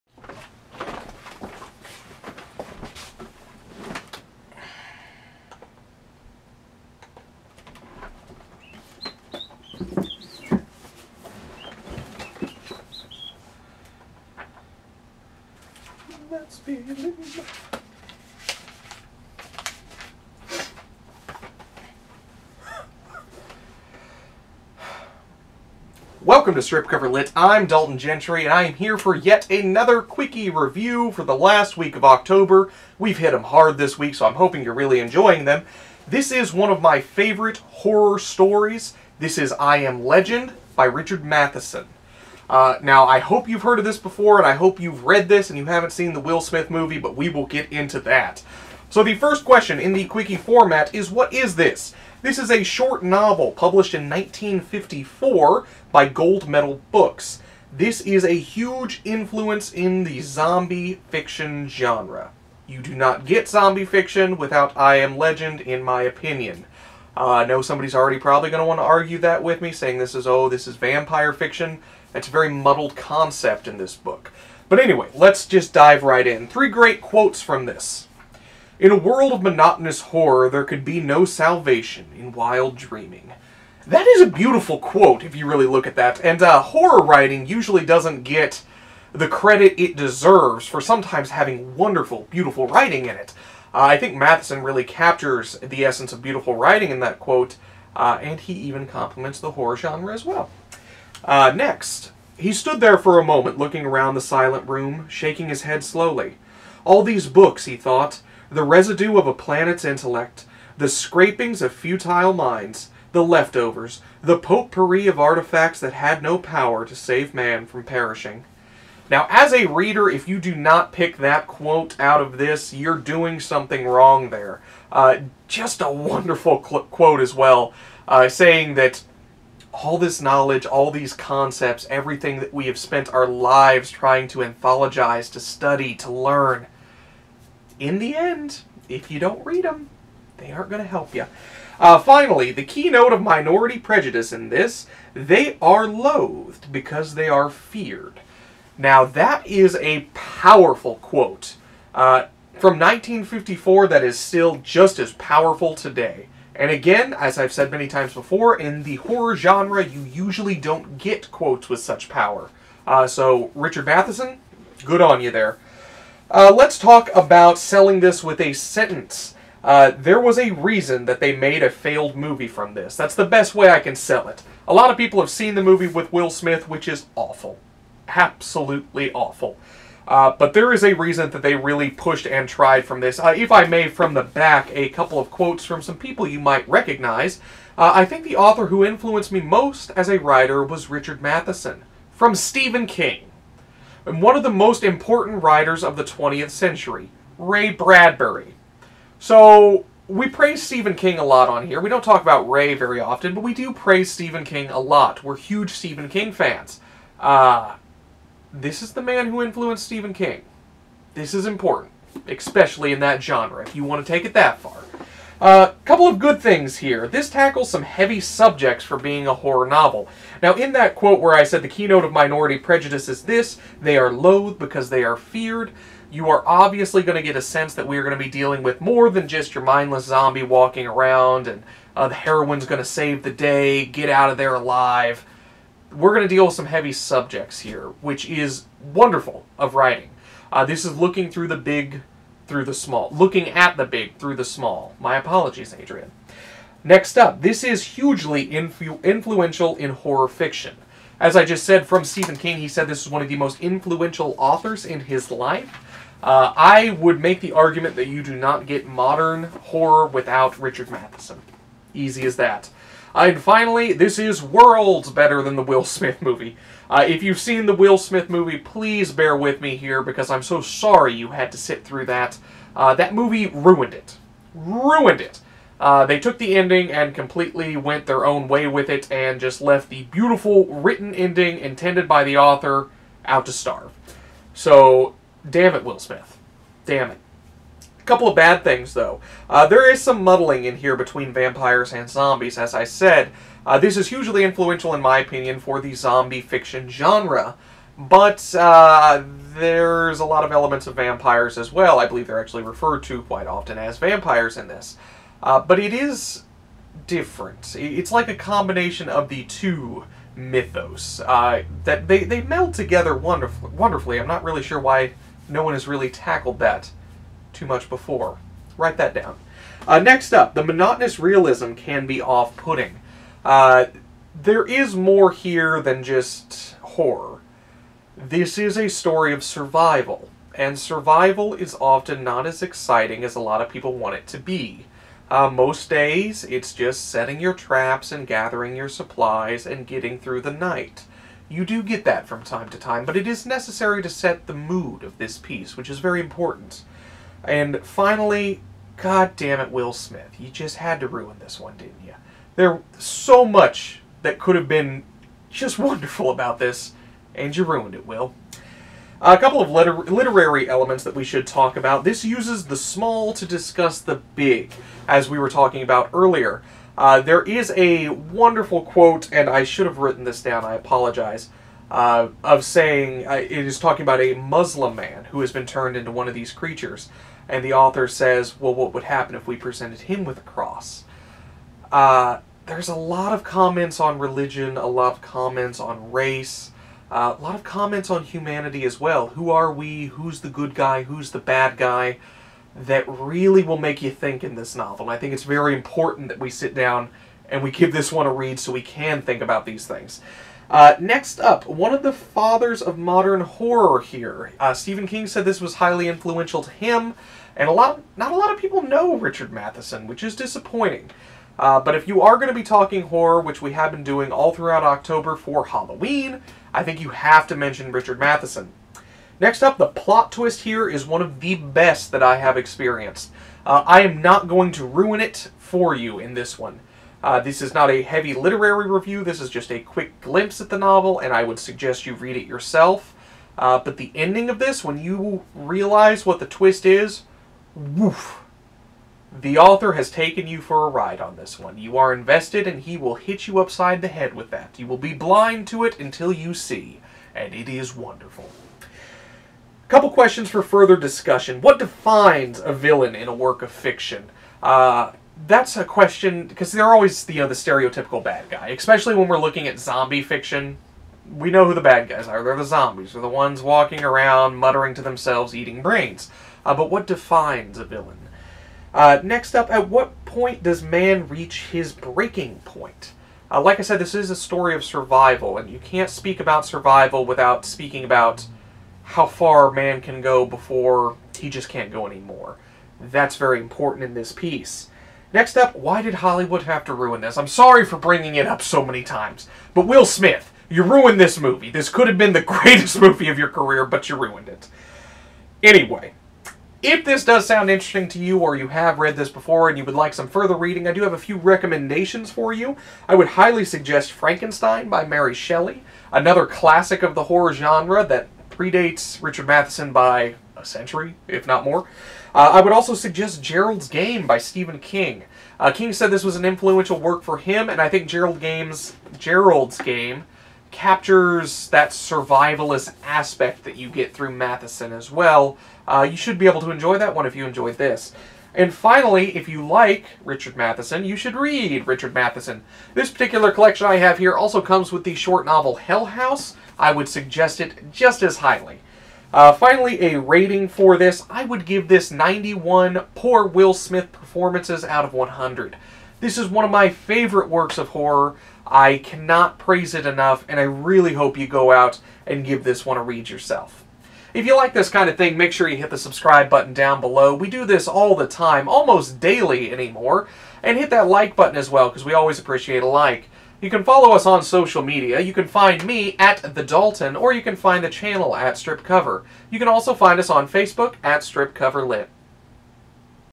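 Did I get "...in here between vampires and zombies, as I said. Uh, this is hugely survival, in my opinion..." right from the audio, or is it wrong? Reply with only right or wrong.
wrong.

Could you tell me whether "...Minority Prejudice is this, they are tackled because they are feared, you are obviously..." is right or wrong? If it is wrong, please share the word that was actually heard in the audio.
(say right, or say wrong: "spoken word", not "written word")
wrong: "loathed", not "tackled".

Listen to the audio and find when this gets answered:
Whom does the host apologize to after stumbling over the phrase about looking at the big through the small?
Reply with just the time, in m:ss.
4:05.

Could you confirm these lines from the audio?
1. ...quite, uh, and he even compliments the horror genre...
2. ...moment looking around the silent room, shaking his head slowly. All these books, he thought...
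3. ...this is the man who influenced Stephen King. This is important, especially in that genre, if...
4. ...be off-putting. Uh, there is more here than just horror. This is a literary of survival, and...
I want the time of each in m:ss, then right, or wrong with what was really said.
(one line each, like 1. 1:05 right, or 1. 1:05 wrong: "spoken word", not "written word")
1. 1:37 wrong: "quote", not "quite"
2. 1:43 right
3. 3:28 right
4. 5:22 wrong: "story", not "literary".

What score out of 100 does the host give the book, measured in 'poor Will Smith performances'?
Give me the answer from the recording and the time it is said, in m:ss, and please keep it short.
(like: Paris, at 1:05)
91, at 9:02.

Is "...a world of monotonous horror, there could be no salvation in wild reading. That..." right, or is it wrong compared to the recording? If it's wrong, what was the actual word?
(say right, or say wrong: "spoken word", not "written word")
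wrong: "dreaming", not "reading".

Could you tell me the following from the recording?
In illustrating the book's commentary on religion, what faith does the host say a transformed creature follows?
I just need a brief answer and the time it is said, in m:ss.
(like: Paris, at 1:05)
Muslim, at 6:14.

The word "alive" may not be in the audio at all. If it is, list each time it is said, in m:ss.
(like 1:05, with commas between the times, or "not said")
3:54.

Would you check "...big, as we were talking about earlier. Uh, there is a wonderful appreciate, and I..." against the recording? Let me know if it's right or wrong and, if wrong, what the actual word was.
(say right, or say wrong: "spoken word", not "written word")
wrong: "quote", not "appreciate".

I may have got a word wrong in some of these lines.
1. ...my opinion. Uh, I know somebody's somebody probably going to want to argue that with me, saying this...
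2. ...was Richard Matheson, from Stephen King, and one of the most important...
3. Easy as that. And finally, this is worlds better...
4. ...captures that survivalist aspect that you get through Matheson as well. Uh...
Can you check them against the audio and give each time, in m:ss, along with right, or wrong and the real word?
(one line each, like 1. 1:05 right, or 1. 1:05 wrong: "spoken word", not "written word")
1. 1:05 wrong: "already", not "somebody"
2. 3:10 right
3. 4:21 right
4. 8:40 right.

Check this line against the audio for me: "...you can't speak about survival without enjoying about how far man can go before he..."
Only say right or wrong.
wrong.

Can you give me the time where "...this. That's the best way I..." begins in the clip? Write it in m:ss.
2:52.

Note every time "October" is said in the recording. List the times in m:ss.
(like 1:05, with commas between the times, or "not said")
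0:32, 6:54.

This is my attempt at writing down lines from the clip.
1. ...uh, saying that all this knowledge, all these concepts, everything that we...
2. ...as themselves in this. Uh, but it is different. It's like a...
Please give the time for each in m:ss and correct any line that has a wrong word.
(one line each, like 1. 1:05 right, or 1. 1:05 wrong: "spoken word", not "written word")
1. 2:08 right
2. 5:03 wrong: "vampires", not "themselves".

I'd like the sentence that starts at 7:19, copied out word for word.
The author has taken you for a ride on this one.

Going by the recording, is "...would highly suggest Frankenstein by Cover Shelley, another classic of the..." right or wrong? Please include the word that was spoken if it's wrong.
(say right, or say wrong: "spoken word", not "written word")
wrong: "Mary", not "Cover".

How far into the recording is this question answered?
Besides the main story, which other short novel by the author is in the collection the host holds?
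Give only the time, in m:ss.
8:55.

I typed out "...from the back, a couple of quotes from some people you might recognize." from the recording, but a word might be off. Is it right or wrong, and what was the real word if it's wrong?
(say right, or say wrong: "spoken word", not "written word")
right.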